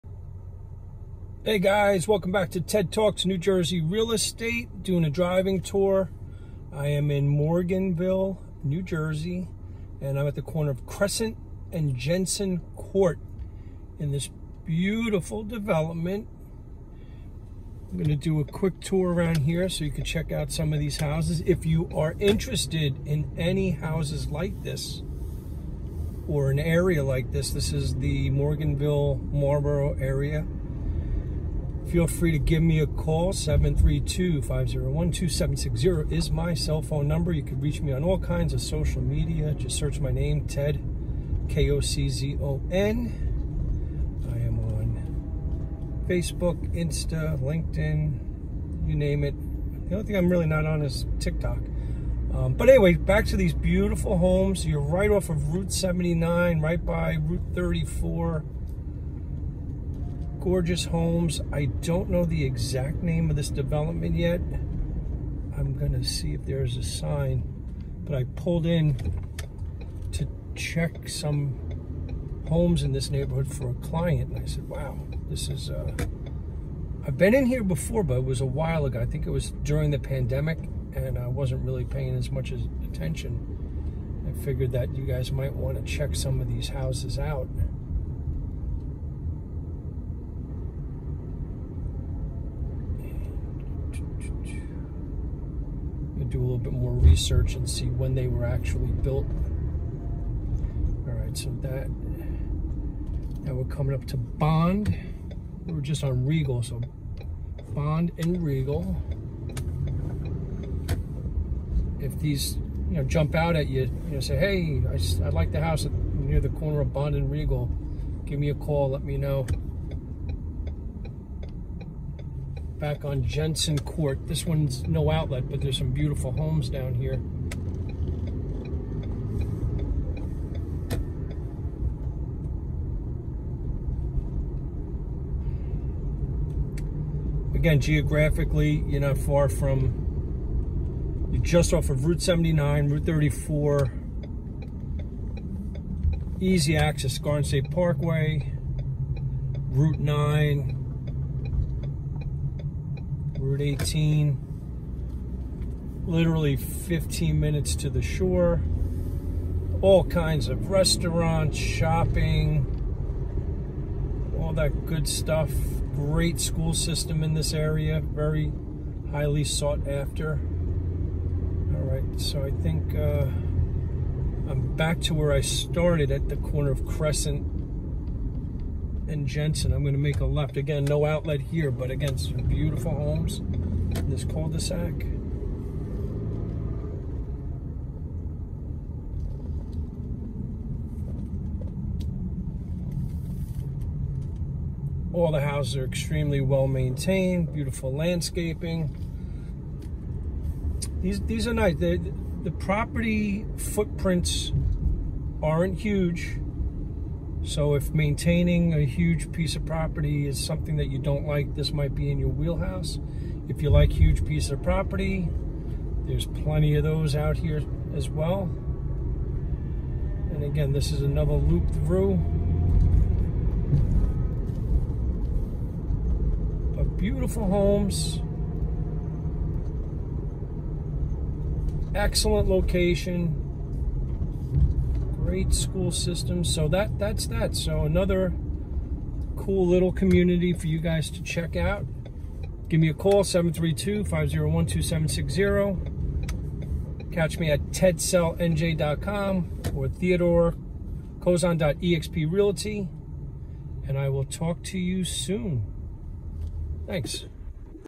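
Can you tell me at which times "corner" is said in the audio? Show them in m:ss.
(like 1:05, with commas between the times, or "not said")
0:10, 1:56, 2:56.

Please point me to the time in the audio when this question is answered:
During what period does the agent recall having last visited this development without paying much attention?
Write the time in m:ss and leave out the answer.
1:19.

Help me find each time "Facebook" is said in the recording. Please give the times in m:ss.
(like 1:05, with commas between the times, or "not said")
0:46.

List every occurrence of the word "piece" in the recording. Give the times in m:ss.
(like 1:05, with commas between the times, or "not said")
3:29, 3:34.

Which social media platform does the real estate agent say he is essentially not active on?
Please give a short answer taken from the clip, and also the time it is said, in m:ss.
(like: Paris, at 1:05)
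TikTok, at 0:51.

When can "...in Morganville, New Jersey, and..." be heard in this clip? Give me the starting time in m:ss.
0:07.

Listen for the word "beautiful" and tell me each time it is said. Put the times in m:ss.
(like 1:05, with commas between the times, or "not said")
0:14, 0:53, 2:05, 3:02, 3:17, 3:46.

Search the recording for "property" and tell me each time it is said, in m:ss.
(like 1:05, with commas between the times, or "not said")
3:22, 3:29, 3:34.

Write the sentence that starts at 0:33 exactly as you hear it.
732-501-2760 is my cell phone number.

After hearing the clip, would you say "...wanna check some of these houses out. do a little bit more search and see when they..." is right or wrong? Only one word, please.
wrong.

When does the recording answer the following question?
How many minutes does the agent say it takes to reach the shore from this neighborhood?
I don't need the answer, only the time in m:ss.
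2:36.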